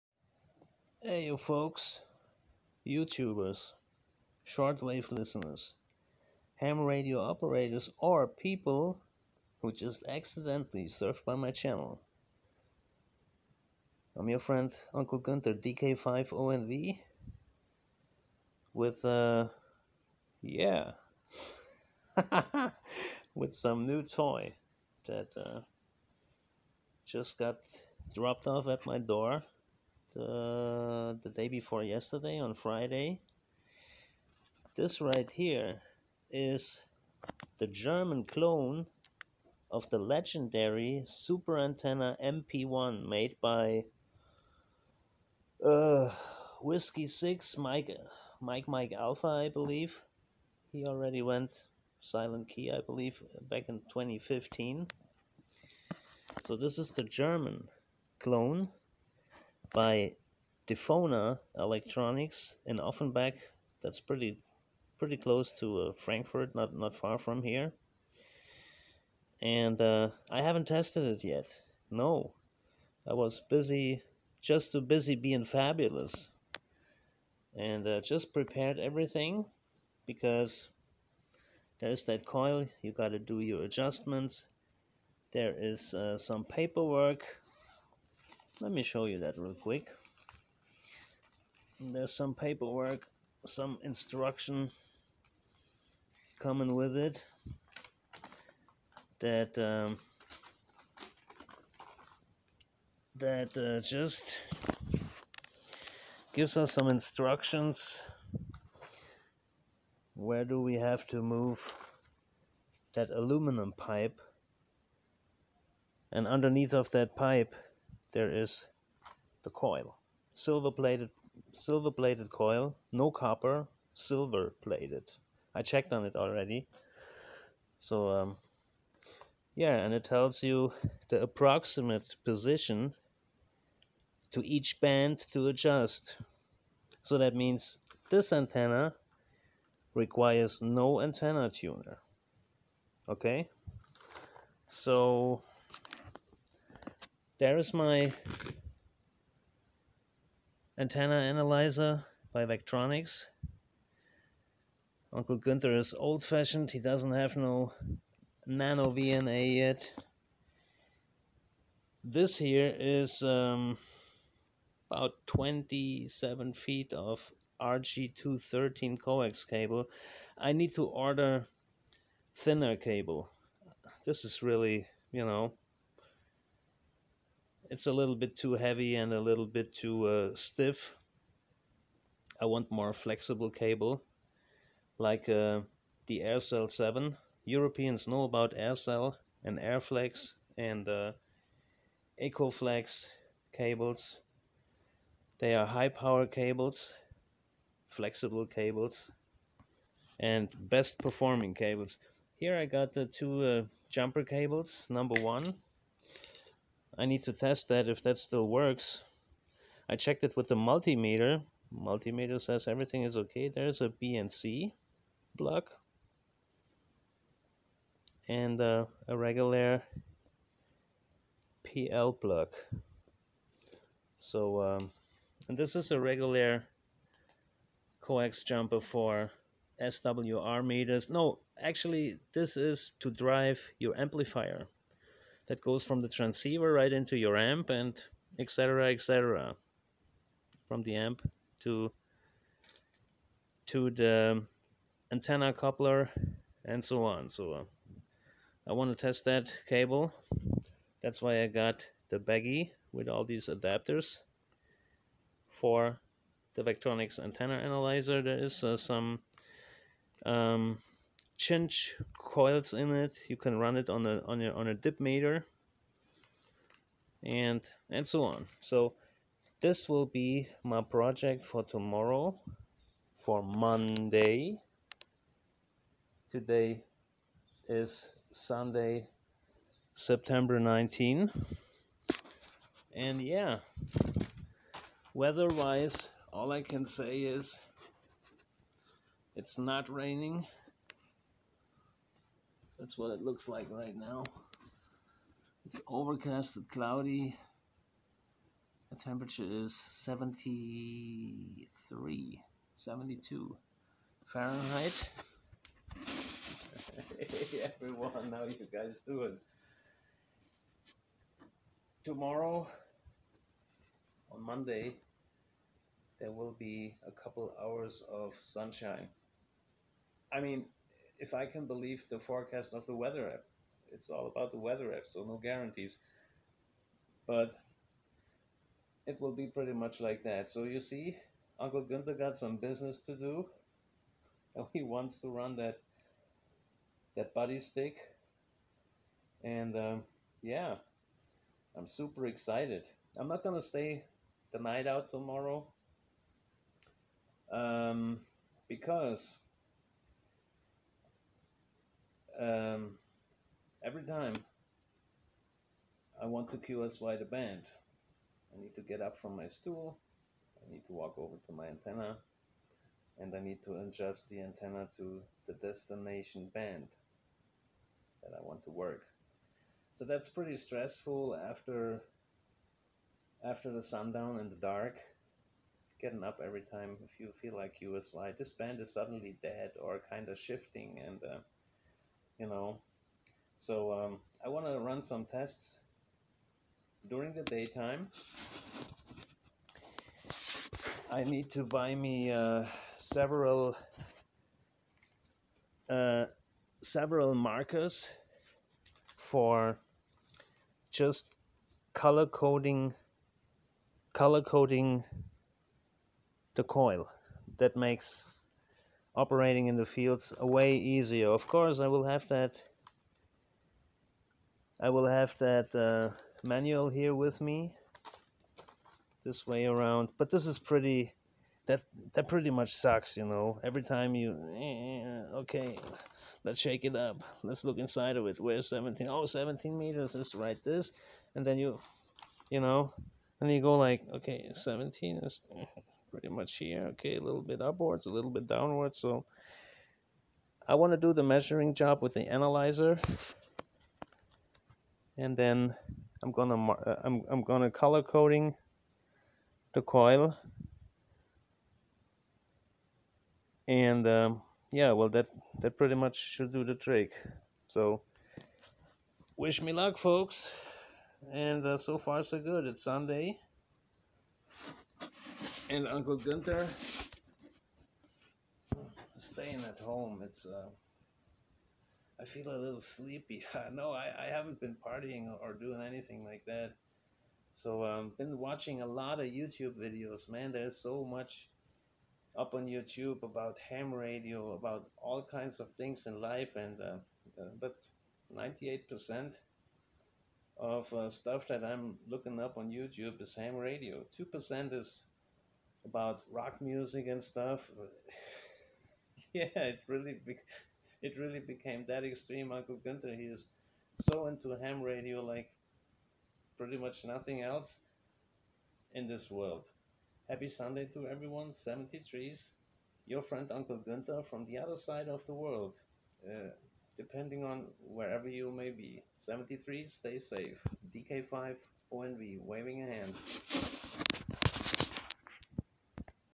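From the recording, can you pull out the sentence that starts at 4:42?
And yeah, weather wise, all I can say is it's not raining.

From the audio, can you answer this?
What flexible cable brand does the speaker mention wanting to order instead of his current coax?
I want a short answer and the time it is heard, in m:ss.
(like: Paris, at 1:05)
AirCell 7, at 3:06.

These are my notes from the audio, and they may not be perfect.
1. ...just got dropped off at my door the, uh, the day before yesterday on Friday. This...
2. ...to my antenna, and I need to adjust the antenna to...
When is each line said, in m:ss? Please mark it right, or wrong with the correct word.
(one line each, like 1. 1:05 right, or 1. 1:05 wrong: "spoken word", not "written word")
1. 0:27 right
2. 6:01 right.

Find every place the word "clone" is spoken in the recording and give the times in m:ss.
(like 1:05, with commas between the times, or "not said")
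0:38, 0:58.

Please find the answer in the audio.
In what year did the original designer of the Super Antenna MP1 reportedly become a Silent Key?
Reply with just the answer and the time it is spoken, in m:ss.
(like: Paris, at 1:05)
2015, at 0:53.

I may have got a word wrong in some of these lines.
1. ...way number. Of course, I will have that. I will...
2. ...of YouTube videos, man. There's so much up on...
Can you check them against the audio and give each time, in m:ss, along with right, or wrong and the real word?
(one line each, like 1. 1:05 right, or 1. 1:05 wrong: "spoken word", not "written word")
1. 6:50 wrong: "easier", not "number"
2. 7:59 right.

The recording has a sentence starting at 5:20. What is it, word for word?
I mean, if I can believe the forecast of the weather app.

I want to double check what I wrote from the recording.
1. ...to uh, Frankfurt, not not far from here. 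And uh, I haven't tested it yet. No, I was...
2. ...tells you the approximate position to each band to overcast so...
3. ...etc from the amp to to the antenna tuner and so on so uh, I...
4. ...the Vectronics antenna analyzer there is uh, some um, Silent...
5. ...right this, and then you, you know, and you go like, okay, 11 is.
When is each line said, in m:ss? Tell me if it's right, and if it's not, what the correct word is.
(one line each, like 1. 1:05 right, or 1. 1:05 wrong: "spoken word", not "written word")
1. 1:05 right
2. 2:10 wrong: "adjust", not "overcast"
3. 3:58 wrong: "coupler", not "tuner"
4. 4:16 wrong: "Change", not "Silent"
5. 7:10 wrong: "17", not "11".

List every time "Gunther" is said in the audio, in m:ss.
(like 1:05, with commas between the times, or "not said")
0:15, 2:35, 7:46, 8:22, 8:33.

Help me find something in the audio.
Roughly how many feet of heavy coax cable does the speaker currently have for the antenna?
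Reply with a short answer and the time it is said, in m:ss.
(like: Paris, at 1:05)
27 feet, at 2:45.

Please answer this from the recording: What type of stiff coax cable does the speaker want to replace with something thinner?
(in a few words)
RG213.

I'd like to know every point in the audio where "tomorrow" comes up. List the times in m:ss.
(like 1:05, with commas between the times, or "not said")
4:31, 5:12, 5:45.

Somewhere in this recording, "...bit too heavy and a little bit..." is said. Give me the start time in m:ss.
2:58.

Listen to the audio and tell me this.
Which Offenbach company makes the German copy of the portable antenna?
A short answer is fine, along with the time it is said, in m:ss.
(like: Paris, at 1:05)
Difona Electronics, at 1:00.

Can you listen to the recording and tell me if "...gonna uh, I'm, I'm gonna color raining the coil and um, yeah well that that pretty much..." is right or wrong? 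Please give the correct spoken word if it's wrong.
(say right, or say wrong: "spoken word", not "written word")
wrong: "coding", not "raining".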